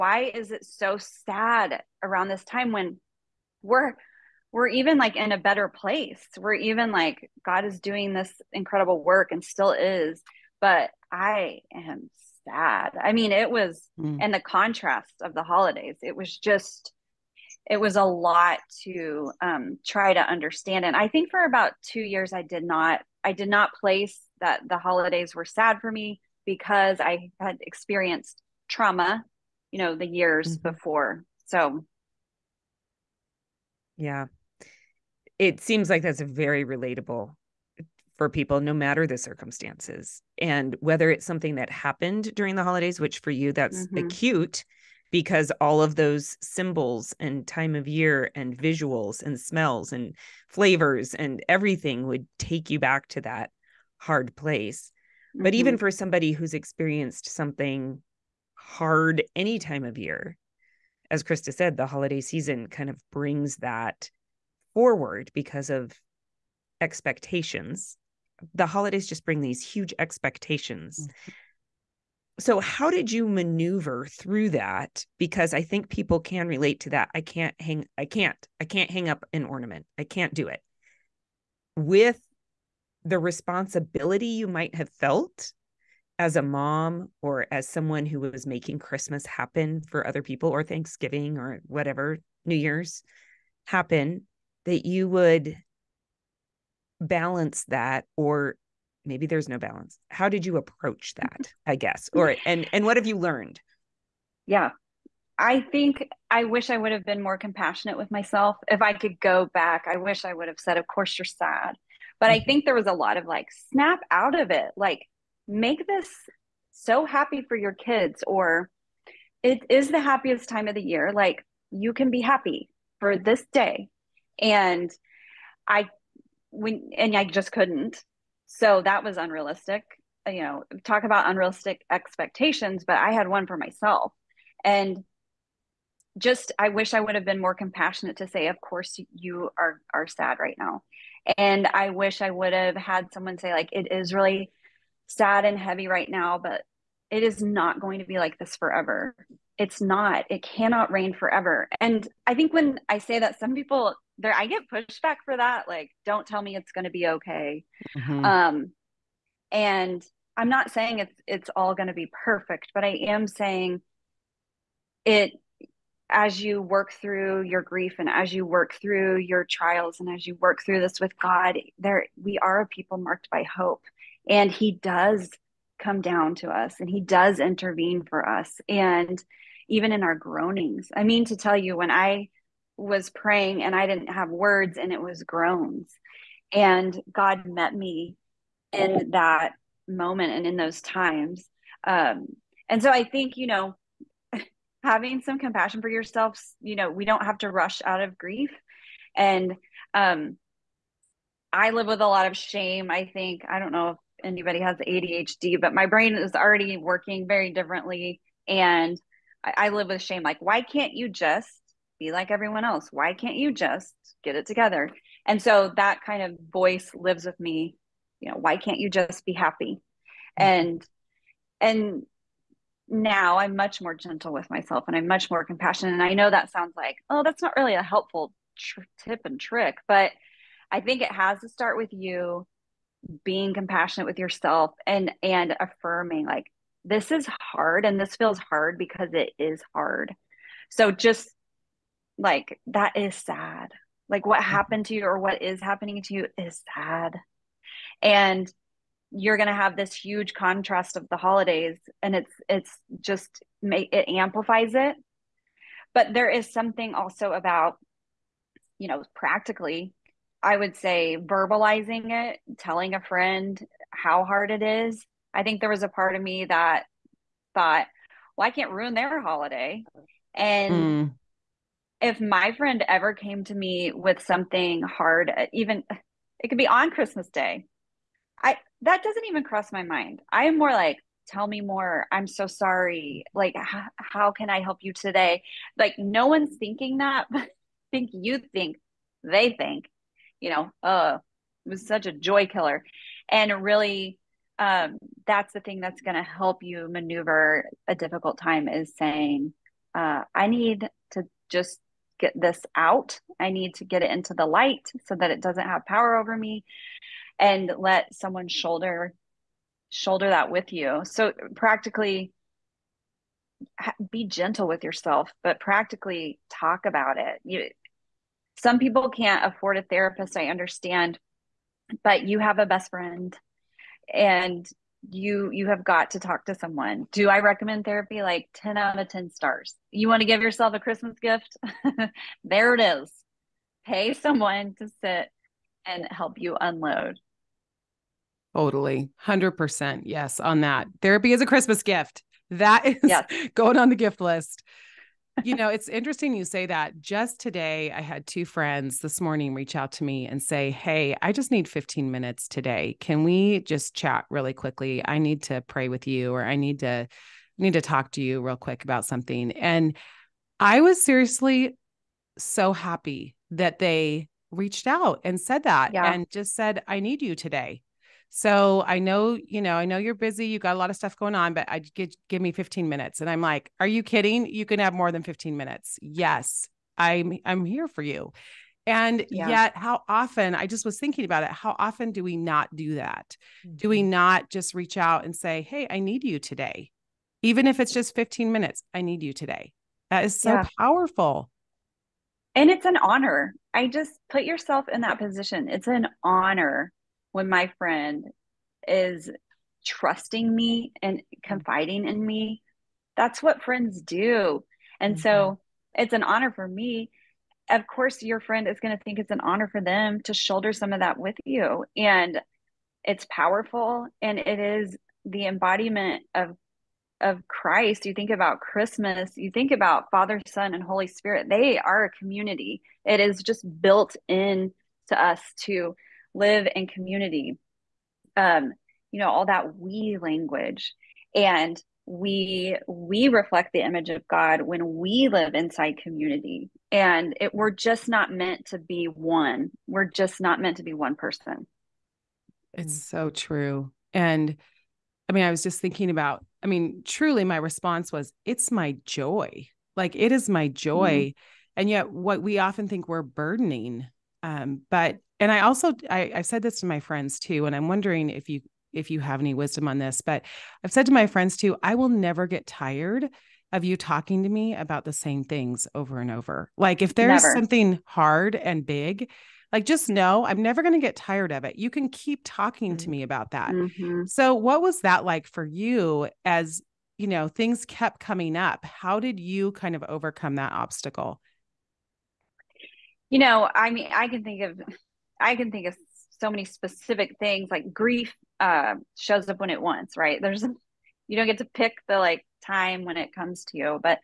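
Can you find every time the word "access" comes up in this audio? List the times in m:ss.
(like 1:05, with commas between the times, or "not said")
not said.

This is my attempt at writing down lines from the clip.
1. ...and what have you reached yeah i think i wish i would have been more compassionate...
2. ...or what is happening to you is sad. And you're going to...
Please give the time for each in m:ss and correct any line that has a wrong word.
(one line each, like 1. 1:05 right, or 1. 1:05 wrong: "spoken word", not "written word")
1. 1:42 wrong: "learned", not "reached"
2. 4:05 right.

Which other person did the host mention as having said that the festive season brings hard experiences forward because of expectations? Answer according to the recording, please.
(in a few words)
Krista.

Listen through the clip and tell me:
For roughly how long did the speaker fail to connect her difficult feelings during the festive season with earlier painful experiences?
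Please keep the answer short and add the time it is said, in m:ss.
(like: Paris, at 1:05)
2 years, at 0:21.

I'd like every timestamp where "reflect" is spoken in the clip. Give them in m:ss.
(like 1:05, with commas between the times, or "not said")
7:13.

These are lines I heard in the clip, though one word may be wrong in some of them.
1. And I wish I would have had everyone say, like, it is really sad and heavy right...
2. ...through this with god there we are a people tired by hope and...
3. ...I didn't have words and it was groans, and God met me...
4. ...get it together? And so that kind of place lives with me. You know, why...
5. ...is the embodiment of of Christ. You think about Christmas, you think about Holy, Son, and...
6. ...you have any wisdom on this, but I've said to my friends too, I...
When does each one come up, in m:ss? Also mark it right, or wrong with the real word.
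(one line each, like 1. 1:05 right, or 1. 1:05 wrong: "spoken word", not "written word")
1. 2:21 wrong: "someone", not "everyone"
2. 2:50 wrong: "marked", not "tired"
3. 3:03 right
4. 3:34 wrong: "voice", not "place"
5. 6:54 wrong: "Father", not "Holy"
6. 7:39 right.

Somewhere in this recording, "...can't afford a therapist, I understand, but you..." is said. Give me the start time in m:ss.
5:19.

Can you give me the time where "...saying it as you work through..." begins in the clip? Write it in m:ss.
2:43.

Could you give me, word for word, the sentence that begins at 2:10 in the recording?
You know, talk about unrealistic expectations, but I had one for myself.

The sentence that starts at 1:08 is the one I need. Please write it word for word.
The holidays just bring these huge expectations.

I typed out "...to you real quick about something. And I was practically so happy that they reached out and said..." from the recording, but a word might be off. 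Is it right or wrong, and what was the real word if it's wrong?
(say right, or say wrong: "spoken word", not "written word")
wrong: "seriously", not "practically".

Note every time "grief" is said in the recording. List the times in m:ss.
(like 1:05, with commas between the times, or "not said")
2:47, 3:18, 8:07.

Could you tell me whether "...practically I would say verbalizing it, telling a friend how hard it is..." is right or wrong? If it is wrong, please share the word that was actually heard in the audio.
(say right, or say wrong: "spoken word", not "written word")
right.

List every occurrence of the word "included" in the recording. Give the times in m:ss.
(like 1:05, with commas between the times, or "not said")
not said.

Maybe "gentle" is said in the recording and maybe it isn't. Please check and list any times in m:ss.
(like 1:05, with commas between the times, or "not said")
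3:43, 5:14.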